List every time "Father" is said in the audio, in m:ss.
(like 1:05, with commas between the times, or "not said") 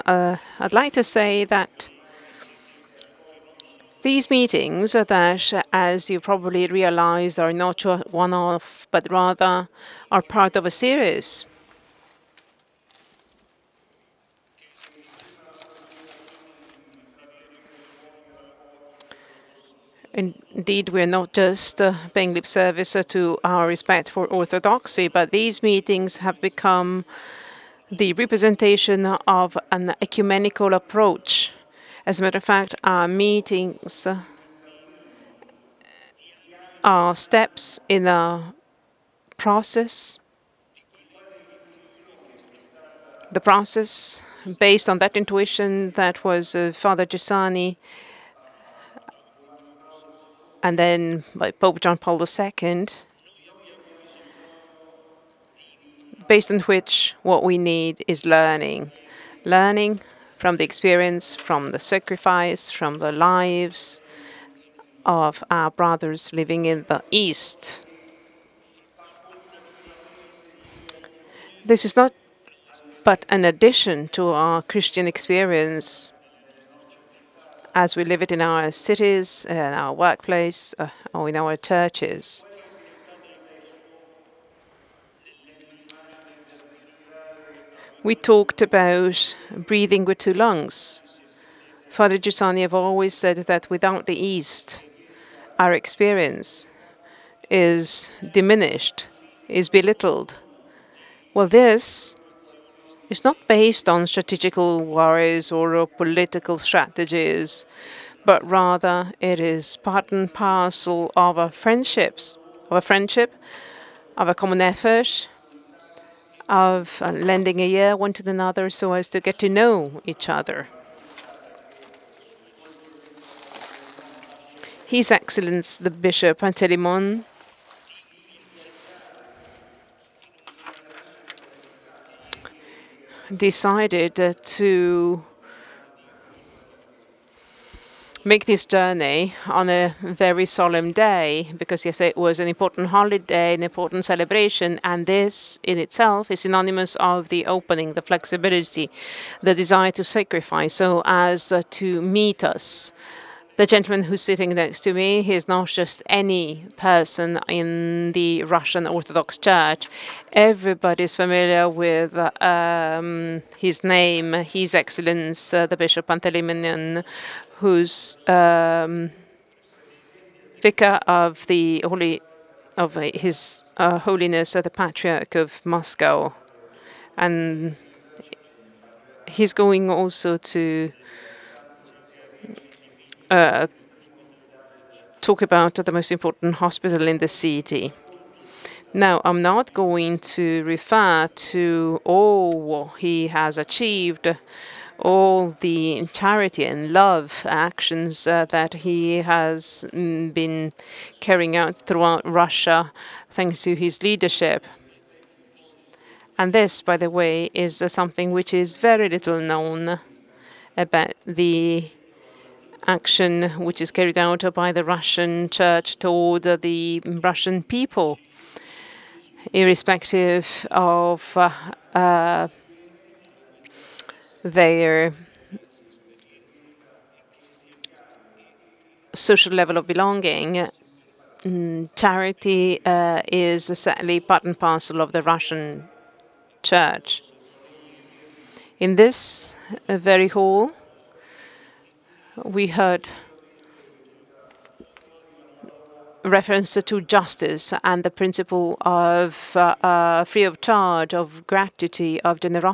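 0:46, 1:31.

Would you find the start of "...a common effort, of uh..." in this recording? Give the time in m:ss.
1:54.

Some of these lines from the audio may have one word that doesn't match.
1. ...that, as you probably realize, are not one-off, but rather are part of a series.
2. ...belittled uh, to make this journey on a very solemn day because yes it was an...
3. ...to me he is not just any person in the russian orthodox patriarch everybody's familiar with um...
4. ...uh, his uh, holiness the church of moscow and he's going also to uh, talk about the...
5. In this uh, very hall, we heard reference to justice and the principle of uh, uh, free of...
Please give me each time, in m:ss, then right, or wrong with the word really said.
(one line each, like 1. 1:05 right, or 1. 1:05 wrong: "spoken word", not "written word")
1. 0:04 right
2. 2:13 wrong: "decided", not "belittled"
3. 2:34 wrong: "church", not "patriarch"
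4. 2:52 wrong: "patriarch", not "church"
5. 3:58 right.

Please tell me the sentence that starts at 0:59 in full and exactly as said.
Learning from the experience, from the sacrifice, from the lives of our brothers living in the East.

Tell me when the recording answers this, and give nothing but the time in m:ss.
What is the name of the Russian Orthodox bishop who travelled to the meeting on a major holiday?
2:06.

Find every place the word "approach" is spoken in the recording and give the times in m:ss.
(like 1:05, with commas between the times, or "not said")
0:30.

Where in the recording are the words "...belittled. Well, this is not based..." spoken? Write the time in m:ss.
1:39.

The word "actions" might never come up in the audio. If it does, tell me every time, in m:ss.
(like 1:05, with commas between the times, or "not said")
3:17, 3:32.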